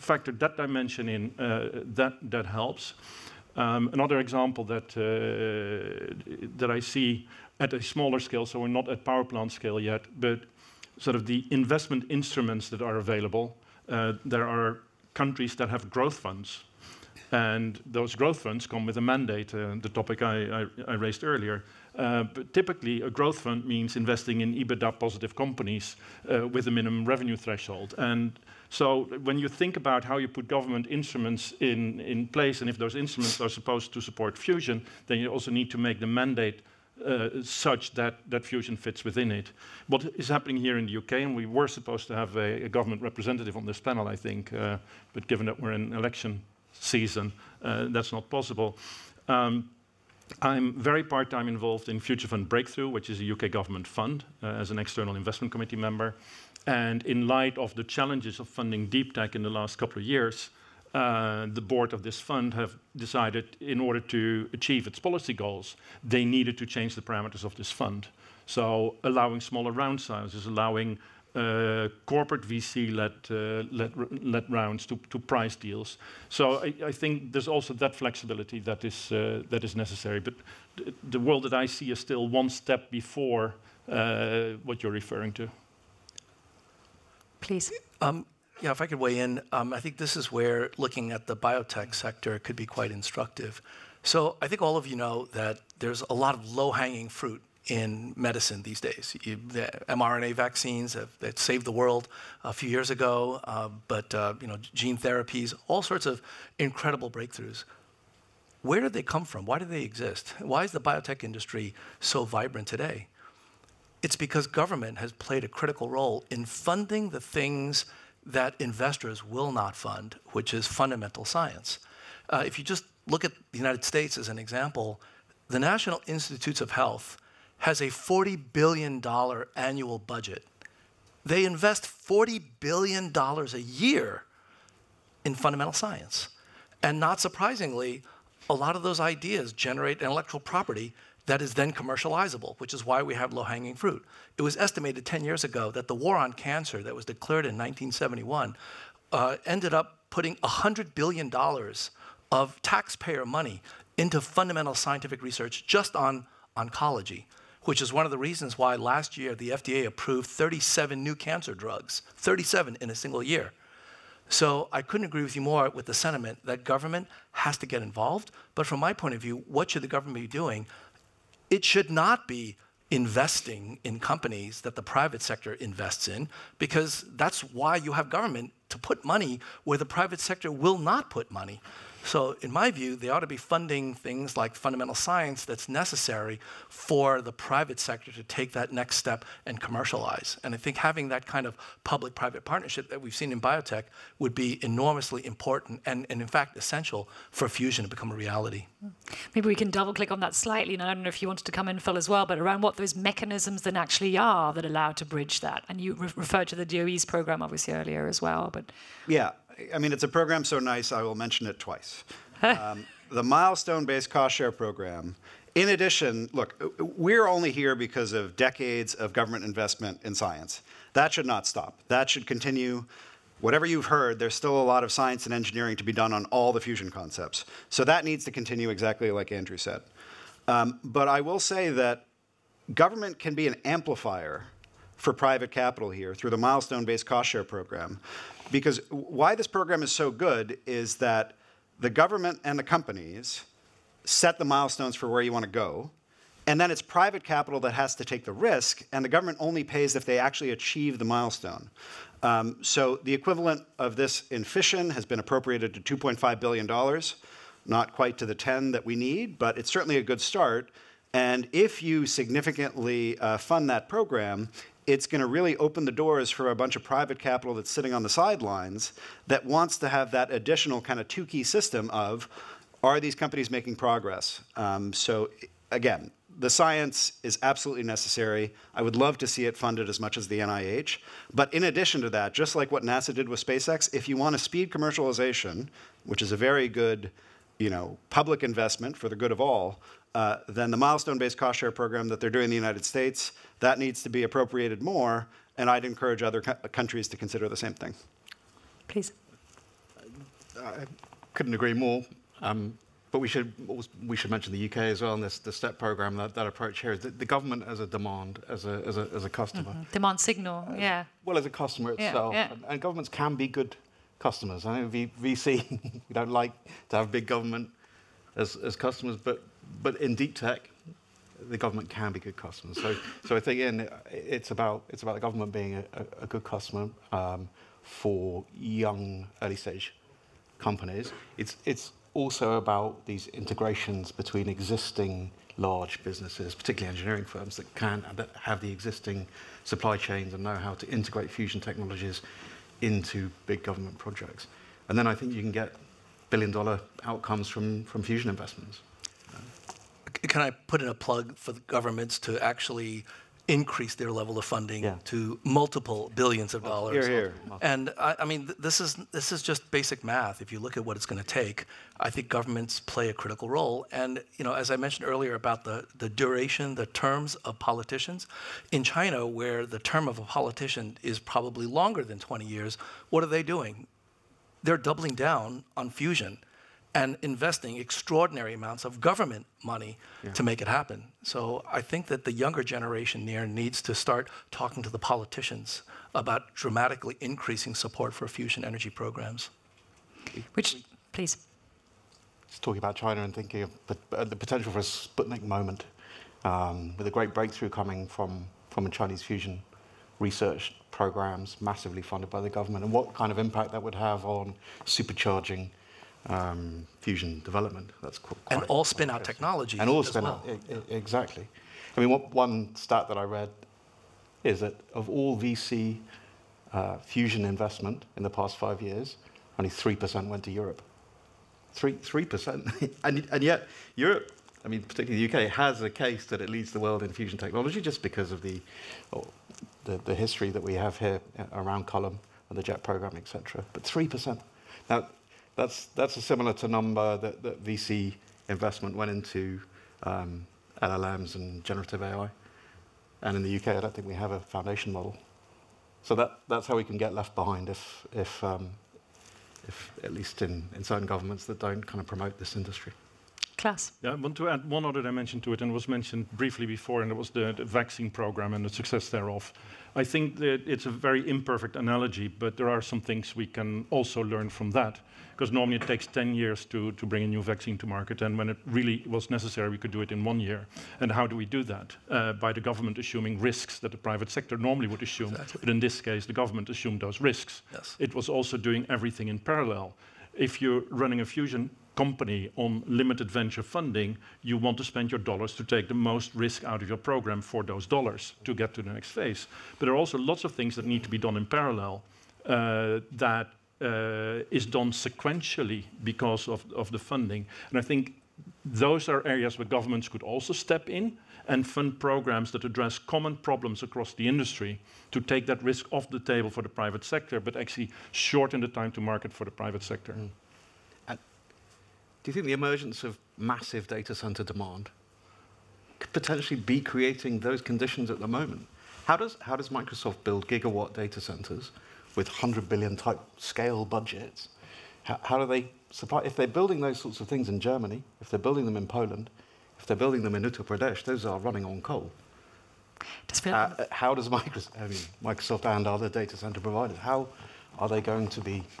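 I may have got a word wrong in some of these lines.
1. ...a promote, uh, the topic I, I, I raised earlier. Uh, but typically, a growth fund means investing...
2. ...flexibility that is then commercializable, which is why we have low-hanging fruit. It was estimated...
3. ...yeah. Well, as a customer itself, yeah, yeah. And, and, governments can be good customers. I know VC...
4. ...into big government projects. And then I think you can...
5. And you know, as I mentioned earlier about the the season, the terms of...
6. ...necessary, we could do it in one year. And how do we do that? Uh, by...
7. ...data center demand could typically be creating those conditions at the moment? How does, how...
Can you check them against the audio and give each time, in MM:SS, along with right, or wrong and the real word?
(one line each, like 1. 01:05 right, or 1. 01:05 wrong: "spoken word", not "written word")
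1. 00:18 wrong: "mandate", not "promote"
2. 02:20 wrong: "property", not "flexibility"
3. 05:10 right
4. 05:42 right
5. 06:03 wrong: "duration", not "season"
6. 07:49 right
7. 08:33 wrong: "potentially", not "typically".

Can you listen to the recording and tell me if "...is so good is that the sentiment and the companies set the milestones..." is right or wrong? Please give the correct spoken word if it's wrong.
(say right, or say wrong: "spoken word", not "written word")
wrong: "government", not "sentiment".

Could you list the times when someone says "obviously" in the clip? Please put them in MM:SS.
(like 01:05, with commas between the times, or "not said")
03:27.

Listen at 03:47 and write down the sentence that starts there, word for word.
So that needs to continue exactly like Andrew said.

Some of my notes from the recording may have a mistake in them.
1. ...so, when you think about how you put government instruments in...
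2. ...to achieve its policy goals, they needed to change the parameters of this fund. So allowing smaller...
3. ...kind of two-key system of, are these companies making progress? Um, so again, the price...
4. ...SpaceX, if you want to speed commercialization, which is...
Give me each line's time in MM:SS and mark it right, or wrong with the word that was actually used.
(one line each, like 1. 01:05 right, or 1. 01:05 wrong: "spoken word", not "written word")
1. 00:28 right
2. 01:03 right
3. 04:30 wrong: "science", not "price"
4. 04:43 right.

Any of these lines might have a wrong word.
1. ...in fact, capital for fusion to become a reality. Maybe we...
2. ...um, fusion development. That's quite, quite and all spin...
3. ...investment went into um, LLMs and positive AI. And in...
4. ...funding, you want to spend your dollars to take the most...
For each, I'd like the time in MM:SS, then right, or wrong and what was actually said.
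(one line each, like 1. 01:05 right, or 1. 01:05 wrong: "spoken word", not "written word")
1. 03:16 wrong: "essential", not "capital"
2. 06:46 right
3. 07:18 wrong: "generative", not "positive"
4. 08:03 right.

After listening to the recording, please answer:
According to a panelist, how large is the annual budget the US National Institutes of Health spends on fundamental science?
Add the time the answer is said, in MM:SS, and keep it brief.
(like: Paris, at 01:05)
$40 billion, at 02:07.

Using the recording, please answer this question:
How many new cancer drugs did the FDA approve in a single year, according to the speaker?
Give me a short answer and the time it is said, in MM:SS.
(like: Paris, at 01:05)
37, at 02:40.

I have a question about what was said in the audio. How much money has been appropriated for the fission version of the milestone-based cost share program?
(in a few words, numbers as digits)
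$2.5 billion.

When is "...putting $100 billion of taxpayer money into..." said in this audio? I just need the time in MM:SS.
02:30.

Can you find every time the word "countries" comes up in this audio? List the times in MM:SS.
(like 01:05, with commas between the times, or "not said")
00:15, 04:56.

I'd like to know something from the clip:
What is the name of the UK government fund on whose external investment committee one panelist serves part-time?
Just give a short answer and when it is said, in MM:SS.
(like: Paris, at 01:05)
Future Fund Breakthrough, at 00:51.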